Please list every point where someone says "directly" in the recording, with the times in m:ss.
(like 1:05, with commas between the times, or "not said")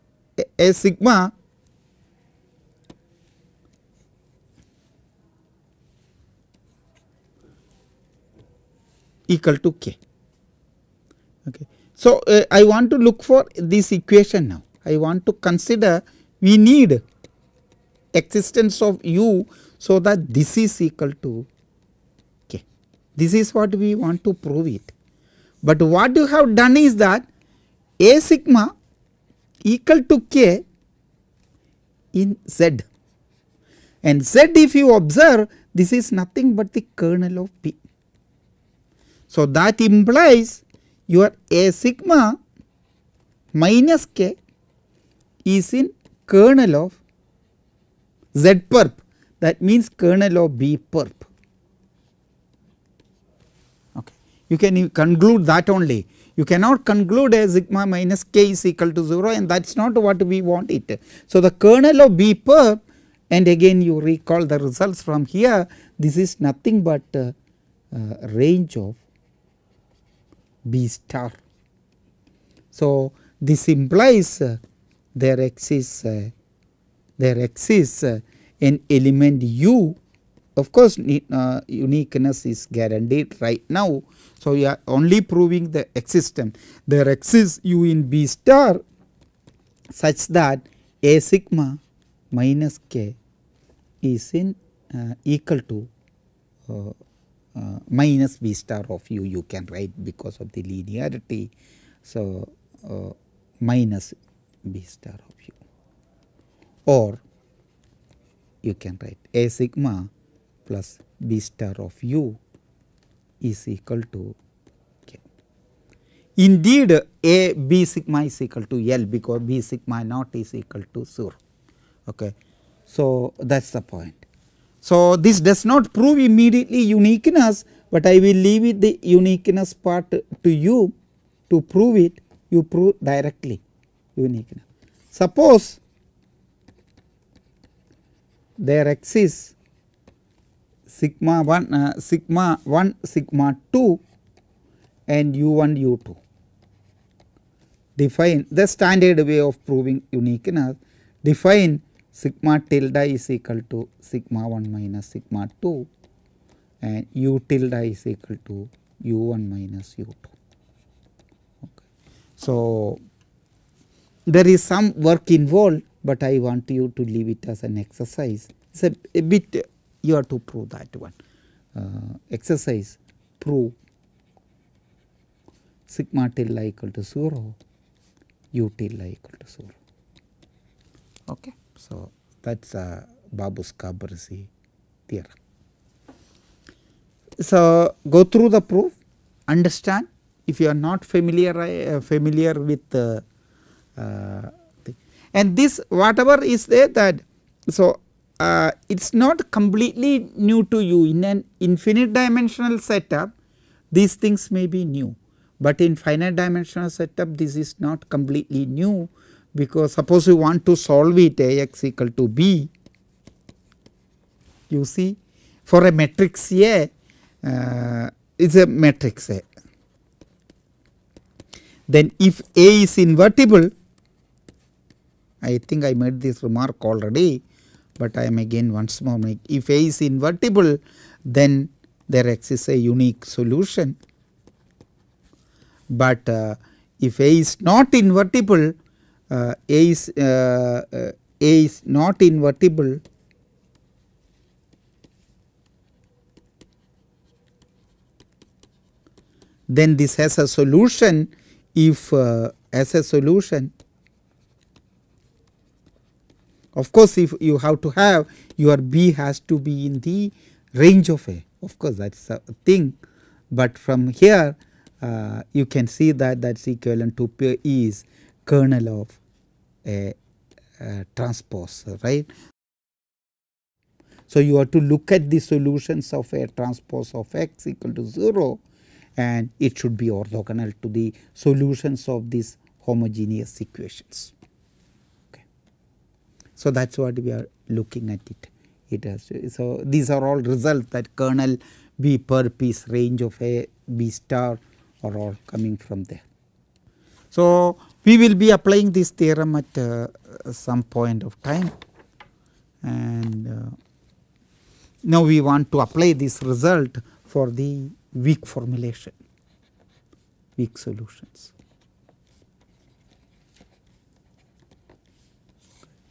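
2:13.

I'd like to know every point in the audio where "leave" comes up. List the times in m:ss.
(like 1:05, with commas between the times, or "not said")
2:08, 2:47.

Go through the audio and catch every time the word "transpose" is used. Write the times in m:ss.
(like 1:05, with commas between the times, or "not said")
4:31, 4:36.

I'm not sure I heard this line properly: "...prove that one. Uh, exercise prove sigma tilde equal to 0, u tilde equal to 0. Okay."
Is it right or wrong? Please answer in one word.
right.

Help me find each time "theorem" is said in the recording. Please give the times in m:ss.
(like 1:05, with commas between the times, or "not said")
3:05, 4:59.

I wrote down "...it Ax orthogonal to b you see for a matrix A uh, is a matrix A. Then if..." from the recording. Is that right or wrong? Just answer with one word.
wrong.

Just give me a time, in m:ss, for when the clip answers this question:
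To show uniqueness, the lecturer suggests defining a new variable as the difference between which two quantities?
2:34.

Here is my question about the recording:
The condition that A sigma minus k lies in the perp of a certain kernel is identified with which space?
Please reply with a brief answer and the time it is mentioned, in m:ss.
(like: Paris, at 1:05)
Range of B star, at 1:08.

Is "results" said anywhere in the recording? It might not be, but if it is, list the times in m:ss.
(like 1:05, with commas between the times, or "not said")
1:04, 4:50, 5:06.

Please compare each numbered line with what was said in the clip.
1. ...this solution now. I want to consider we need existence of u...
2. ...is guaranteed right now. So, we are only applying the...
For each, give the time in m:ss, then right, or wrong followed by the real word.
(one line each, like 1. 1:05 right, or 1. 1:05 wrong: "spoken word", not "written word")
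1. 0:13 wrong: "equation", not "solution"
2. 1:22 wrong: "proving", not "applying".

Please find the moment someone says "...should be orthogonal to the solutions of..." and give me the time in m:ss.
4:39.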